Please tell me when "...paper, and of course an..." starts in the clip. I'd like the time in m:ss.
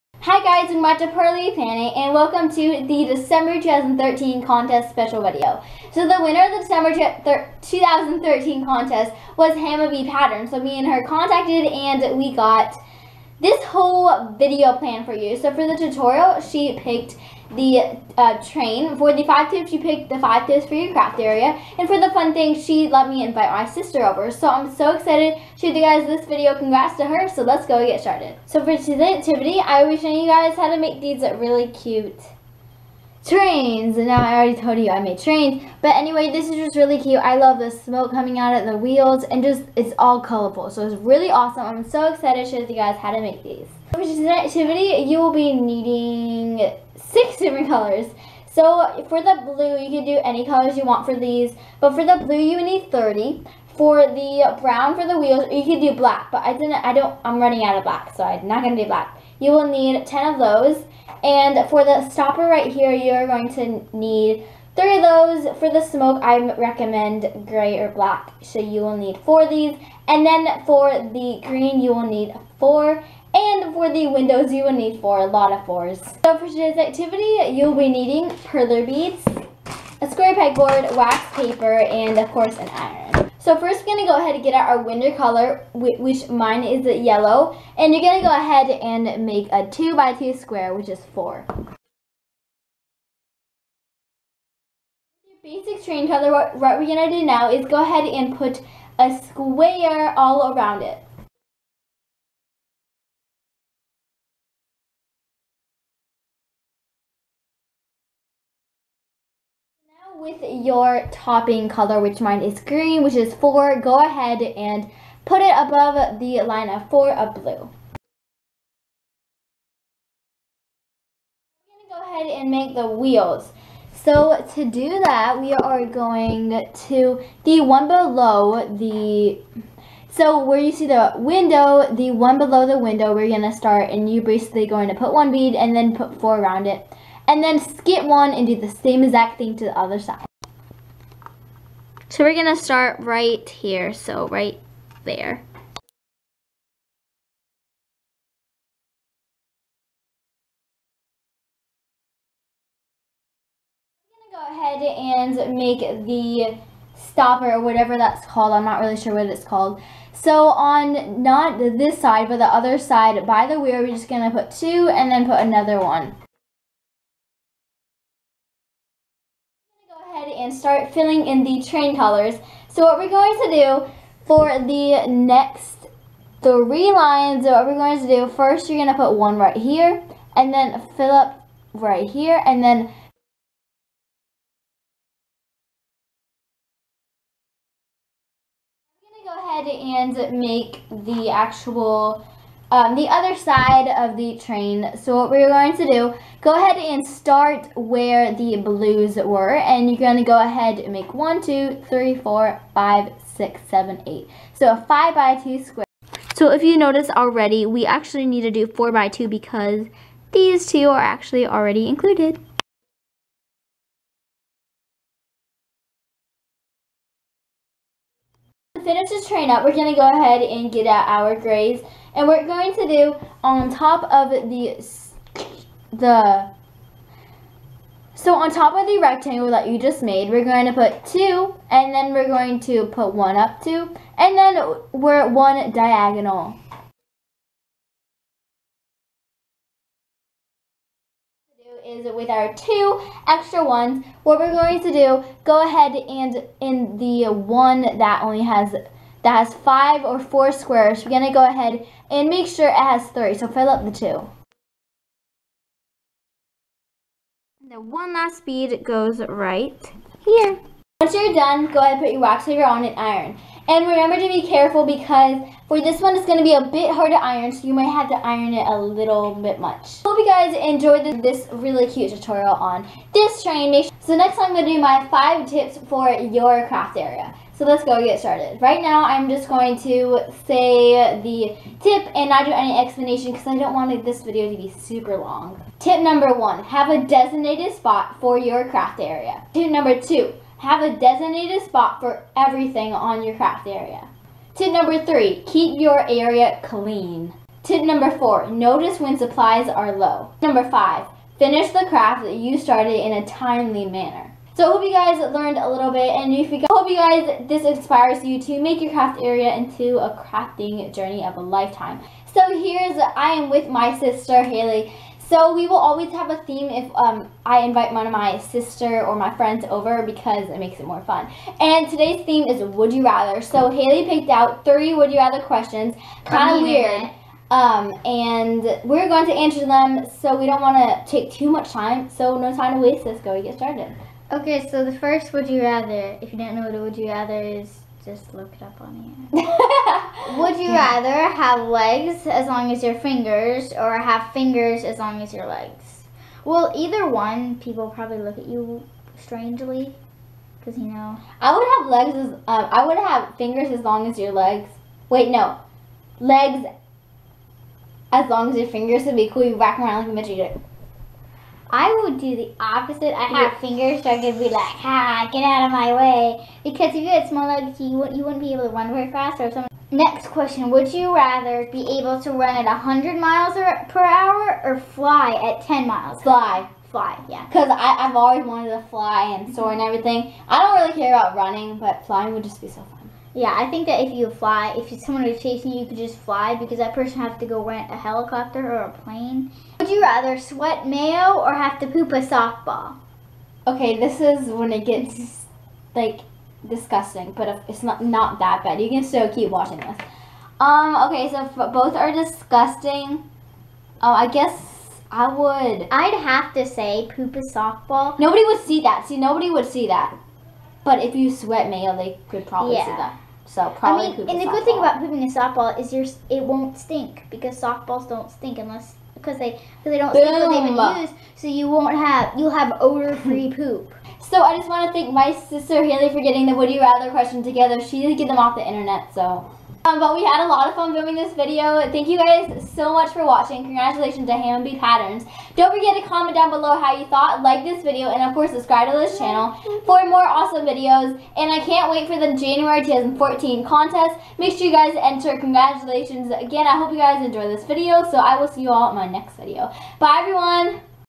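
1:21.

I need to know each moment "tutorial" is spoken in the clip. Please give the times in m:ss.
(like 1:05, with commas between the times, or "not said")
0:15, 4:32.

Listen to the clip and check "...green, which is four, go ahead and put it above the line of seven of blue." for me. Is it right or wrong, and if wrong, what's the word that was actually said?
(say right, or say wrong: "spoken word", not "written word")
wrong: "four", not "seven".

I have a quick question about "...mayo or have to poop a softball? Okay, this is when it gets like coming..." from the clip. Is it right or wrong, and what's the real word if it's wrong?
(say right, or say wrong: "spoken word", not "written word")
wrong: "disgusting", not "coming".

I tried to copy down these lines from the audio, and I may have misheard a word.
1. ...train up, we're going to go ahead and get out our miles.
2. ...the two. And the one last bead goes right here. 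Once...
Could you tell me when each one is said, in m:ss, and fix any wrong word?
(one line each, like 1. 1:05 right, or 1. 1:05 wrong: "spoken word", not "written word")
1. 3:39 wrong: "grades", not "miles"
2. 4:13 right.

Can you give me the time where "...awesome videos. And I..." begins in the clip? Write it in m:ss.
7:20.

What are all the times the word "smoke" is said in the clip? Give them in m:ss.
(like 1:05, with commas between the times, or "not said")
0:37, 1:05.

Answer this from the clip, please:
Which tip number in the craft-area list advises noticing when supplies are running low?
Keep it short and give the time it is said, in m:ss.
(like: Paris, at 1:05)
4, at 4:57.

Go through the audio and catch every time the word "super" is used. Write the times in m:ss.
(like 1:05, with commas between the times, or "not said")
4:44.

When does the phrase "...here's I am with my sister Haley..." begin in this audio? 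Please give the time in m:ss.
5:12.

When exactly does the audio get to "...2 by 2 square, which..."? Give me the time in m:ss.
1:29.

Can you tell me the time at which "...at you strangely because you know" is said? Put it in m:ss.
5:48.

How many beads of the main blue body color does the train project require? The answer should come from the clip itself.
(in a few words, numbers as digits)
30.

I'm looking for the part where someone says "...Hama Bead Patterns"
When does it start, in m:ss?
7:14.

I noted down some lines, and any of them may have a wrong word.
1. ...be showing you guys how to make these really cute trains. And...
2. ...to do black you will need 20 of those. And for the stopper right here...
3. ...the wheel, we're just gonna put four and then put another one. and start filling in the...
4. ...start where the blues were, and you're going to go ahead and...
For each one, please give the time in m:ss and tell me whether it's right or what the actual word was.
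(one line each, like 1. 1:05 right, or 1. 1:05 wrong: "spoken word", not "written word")
1. 0:29 right
2. 0:58 wrong: "10", not "20"
3. 2:43 wrong: "two", not "four"
4. 3:17 right.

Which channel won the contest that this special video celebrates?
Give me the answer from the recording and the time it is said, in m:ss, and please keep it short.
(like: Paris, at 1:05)
Hama Bead Pattern, at 0:09.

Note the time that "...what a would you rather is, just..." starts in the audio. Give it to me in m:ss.
5:36.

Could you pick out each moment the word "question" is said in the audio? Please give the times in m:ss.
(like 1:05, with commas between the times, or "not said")
5:25, 6:10, 7:07.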